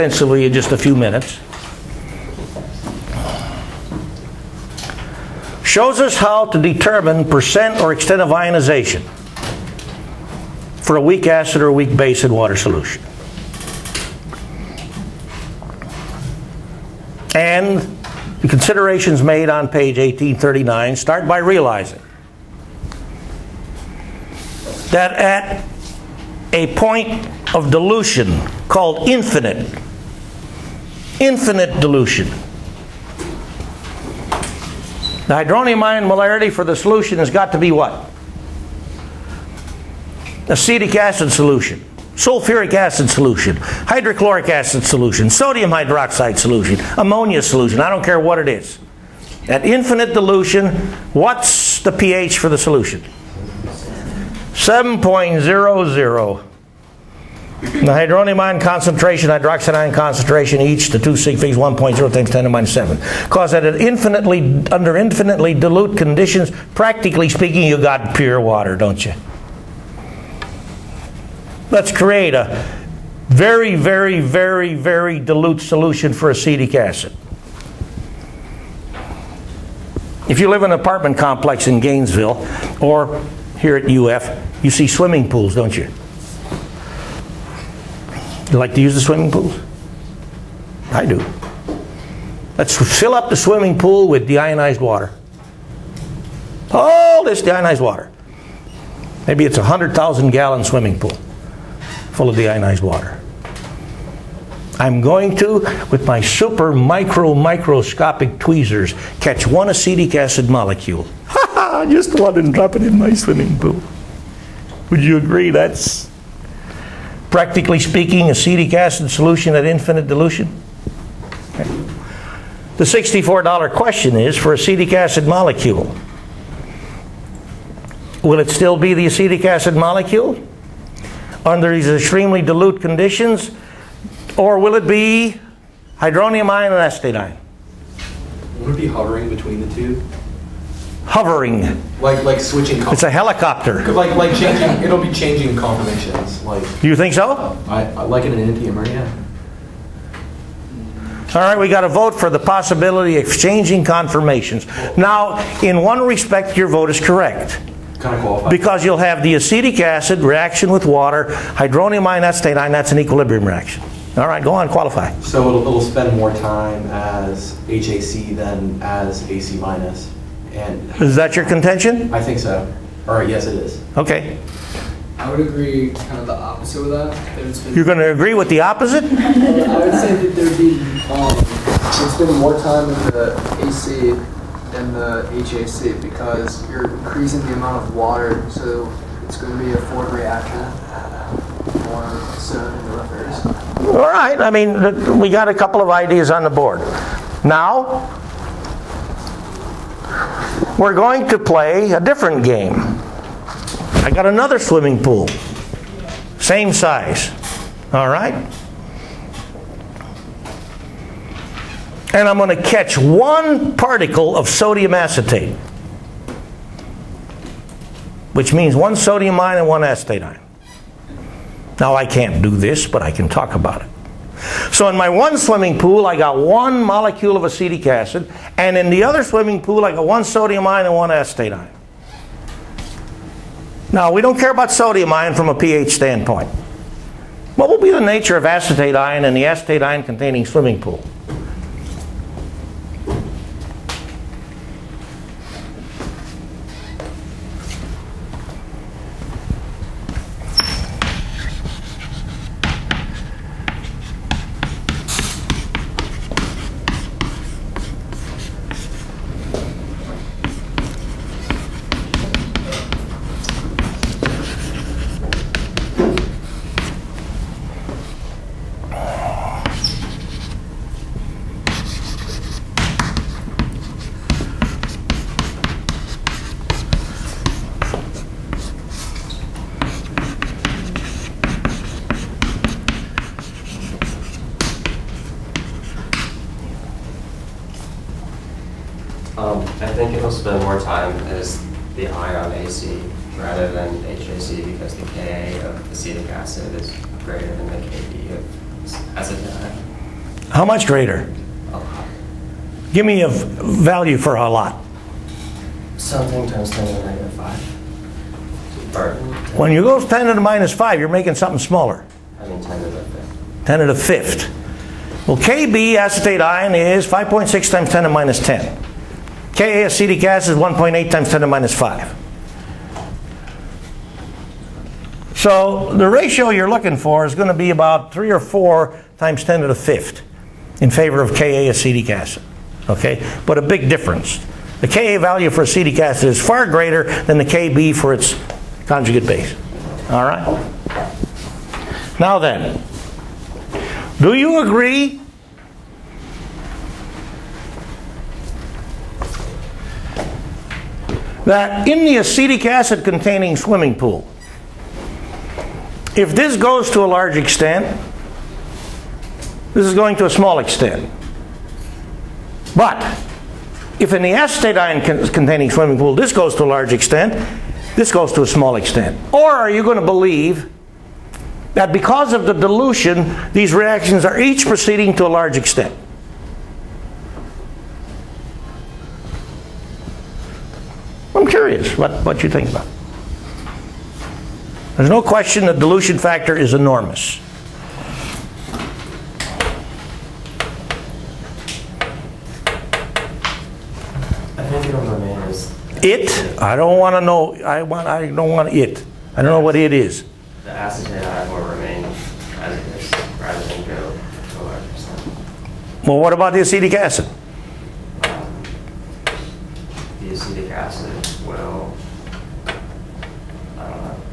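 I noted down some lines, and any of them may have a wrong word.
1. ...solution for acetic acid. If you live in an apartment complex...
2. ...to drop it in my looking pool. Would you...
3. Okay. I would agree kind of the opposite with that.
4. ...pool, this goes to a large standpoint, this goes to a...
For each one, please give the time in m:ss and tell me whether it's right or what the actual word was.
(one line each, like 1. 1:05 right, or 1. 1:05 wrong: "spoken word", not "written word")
1. 1:15 right
2. 1:52 wrong: "swimming", not "looking"
3. 2:53 right
4. 6:05 wrong: "extent", not "standpoint".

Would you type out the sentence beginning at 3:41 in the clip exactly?
Now, I can't do this, but I can talk about it.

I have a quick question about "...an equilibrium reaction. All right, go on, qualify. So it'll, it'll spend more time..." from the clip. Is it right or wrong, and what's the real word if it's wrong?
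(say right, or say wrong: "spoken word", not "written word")
right.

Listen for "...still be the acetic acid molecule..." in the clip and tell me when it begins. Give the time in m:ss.
2:08.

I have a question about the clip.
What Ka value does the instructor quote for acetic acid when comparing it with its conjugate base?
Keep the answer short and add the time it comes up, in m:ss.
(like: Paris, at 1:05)
1.8 x 10^-5, at 5:20.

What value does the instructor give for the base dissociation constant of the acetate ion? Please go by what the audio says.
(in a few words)
5.6 x 10^-10.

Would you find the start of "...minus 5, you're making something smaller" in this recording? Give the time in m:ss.
5:10.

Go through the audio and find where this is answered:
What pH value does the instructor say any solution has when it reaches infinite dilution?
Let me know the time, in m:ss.
0:54.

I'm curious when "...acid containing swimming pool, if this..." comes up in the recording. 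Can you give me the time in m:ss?
5:52.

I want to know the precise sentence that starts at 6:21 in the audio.
curious what, what you think about There's no question the dilution factor is enormous.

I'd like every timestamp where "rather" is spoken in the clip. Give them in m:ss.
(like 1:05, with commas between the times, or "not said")
4:53, 6:43.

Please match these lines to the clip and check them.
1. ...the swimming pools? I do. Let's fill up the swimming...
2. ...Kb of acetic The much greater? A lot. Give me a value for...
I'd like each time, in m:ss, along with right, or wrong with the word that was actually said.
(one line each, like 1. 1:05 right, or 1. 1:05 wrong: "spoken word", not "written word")
1. 1:28 right
2. 4:57 wrong: "How", not "The".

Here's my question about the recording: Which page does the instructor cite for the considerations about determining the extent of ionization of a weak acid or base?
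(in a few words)
1839.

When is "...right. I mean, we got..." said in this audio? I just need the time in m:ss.
3:14.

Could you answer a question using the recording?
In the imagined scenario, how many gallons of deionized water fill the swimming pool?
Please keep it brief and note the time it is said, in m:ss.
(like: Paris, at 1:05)
100,000 gallons, at 1:39.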